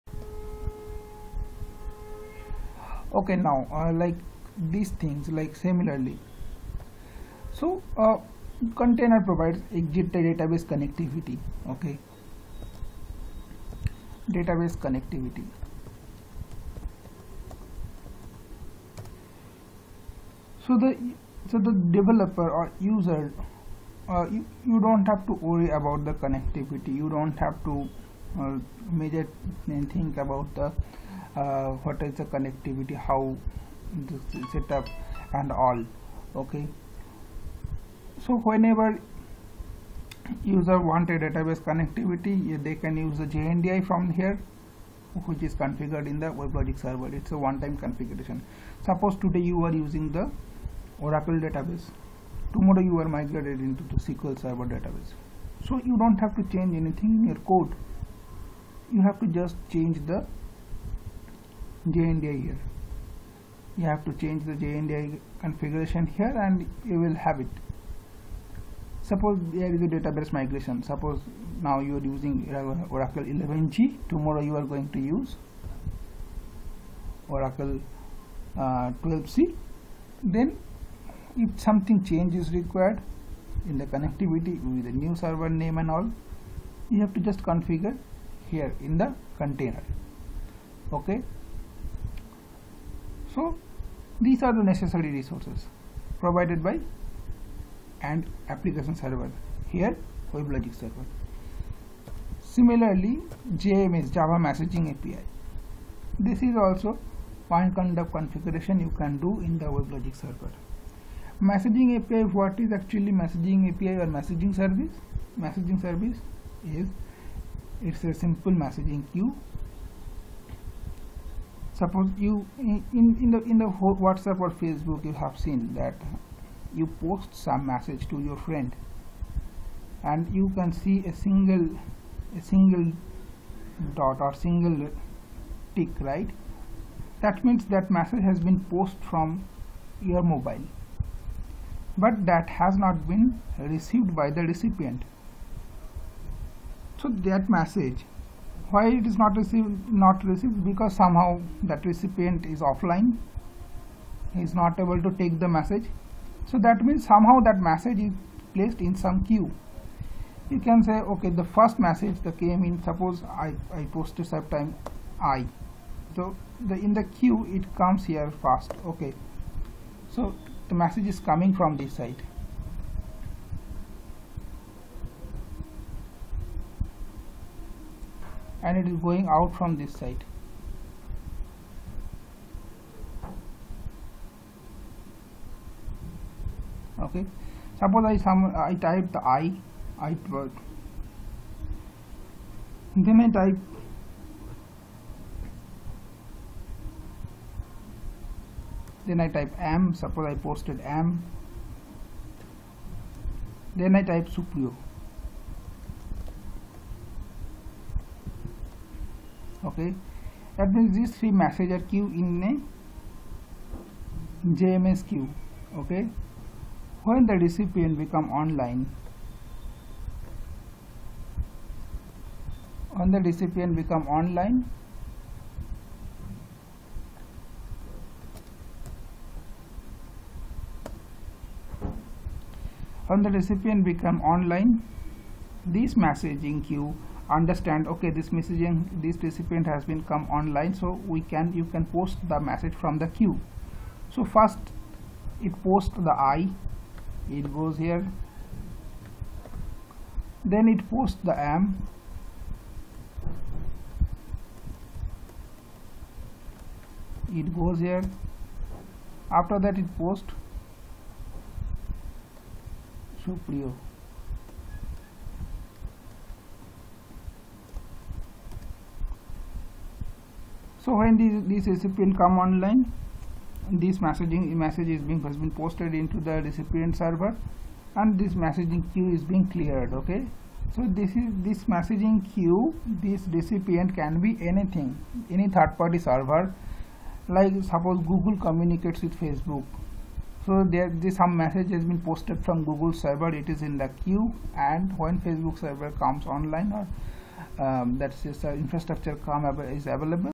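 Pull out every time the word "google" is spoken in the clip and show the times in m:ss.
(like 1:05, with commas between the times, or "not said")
4:48, 4:52.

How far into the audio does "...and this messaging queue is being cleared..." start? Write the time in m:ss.
4:38.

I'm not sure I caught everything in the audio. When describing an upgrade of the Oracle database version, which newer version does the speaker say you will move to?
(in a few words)
Oracle 12c.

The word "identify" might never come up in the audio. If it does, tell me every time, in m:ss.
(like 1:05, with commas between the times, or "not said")
not said.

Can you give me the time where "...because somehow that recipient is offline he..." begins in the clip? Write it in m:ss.
2:30.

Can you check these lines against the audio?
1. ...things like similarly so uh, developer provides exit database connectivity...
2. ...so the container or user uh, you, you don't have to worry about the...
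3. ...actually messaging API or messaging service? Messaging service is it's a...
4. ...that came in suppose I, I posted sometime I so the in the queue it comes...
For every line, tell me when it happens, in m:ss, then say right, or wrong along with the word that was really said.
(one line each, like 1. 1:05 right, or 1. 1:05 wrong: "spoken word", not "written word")
1. 0:05 wrong: "container", not "developer"
2. 0:21 wrong: "developer", not "container"
3. 1:52 right
4. 2:42 right.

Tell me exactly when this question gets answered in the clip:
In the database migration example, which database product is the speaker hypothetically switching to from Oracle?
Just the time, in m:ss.
0:53.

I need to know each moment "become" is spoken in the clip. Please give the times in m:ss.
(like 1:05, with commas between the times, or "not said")
3:37, 3:43, 3:53.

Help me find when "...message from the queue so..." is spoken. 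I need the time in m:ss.
4:02.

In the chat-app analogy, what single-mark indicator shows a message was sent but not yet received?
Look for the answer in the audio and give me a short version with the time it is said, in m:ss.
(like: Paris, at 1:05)
single tick, at 2:14.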